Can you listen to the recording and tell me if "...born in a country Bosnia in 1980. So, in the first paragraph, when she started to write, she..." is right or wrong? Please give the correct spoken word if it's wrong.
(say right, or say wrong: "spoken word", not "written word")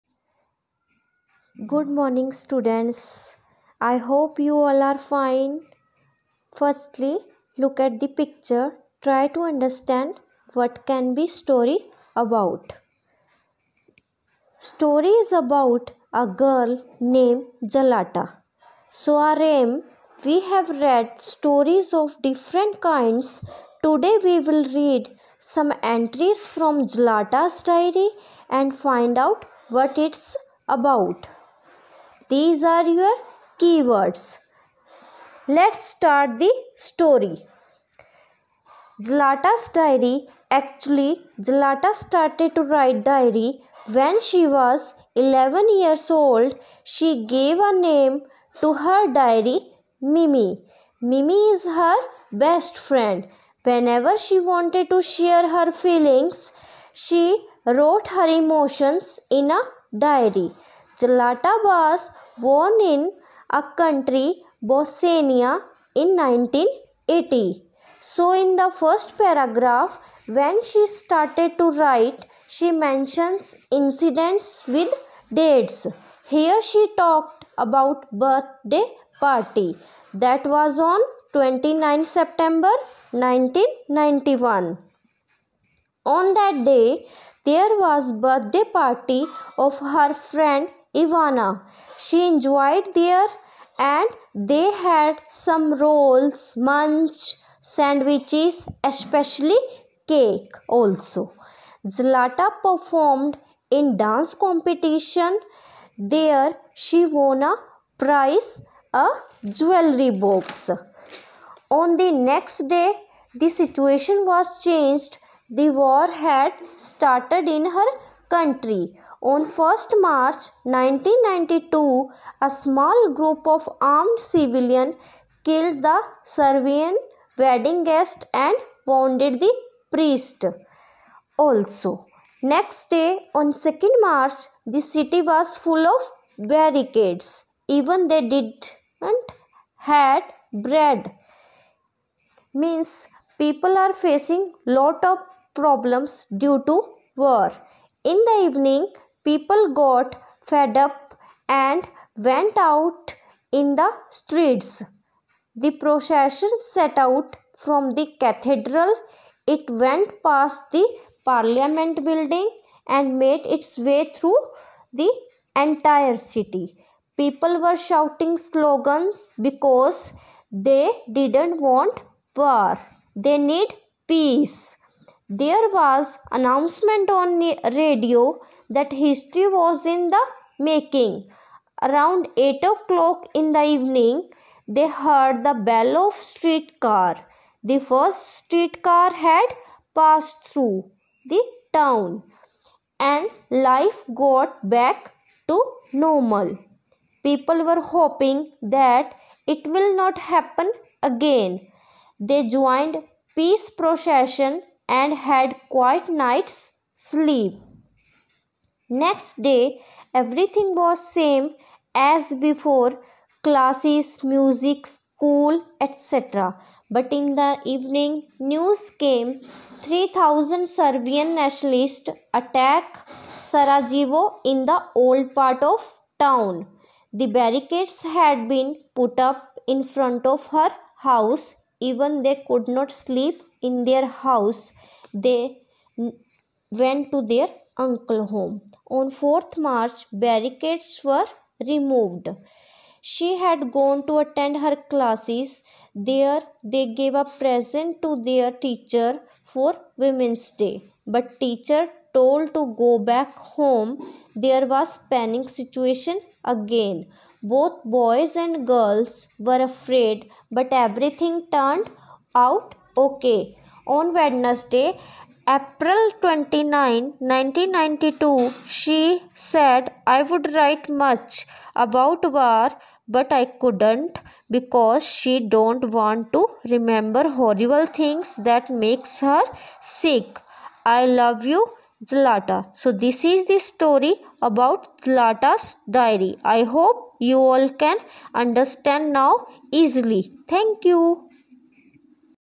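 right.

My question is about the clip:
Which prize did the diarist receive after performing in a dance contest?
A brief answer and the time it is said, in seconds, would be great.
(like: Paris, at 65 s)
A jewelry box, at 108 s.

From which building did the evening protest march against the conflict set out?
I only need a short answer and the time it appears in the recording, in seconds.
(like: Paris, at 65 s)
The cathedral, at 158 s.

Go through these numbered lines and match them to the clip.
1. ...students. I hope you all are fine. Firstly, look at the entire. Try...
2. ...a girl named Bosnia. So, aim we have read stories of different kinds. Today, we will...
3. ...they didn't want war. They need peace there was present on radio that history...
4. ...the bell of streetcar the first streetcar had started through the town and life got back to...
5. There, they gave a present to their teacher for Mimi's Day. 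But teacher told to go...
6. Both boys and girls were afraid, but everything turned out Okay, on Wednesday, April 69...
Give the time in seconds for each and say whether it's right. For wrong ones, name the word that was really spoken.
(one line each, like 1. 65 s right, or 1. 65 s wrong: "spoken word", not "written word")
1. 2 s wrong: "picture", not "entire"
2. 16 s wrong: "Zlata", not "Bosnia"
3. 170 s wrong: "announcement", not "present"
4. 185 s wrong: "passed", not "started"
5. 245 s wrong: "Women", not "Mimi"
6. 257 s wrong: "29", not "69".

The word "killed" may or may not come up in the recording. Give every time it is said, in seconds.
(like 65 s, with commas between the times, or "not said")
125 s.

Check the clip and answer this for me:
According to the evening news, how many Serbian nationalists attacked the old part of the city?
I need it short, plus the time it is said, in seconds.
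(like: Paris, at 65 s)
3,000, at 219 s.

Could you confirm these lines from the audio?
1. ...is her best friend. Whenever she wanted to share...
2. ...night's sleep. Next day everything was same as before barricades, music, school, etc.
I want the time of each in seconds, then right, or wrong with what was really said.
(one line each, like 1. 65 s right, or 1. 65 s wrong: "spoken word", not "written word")
1. 51 s right
2. 206 s wrong: "classes", not "barricades".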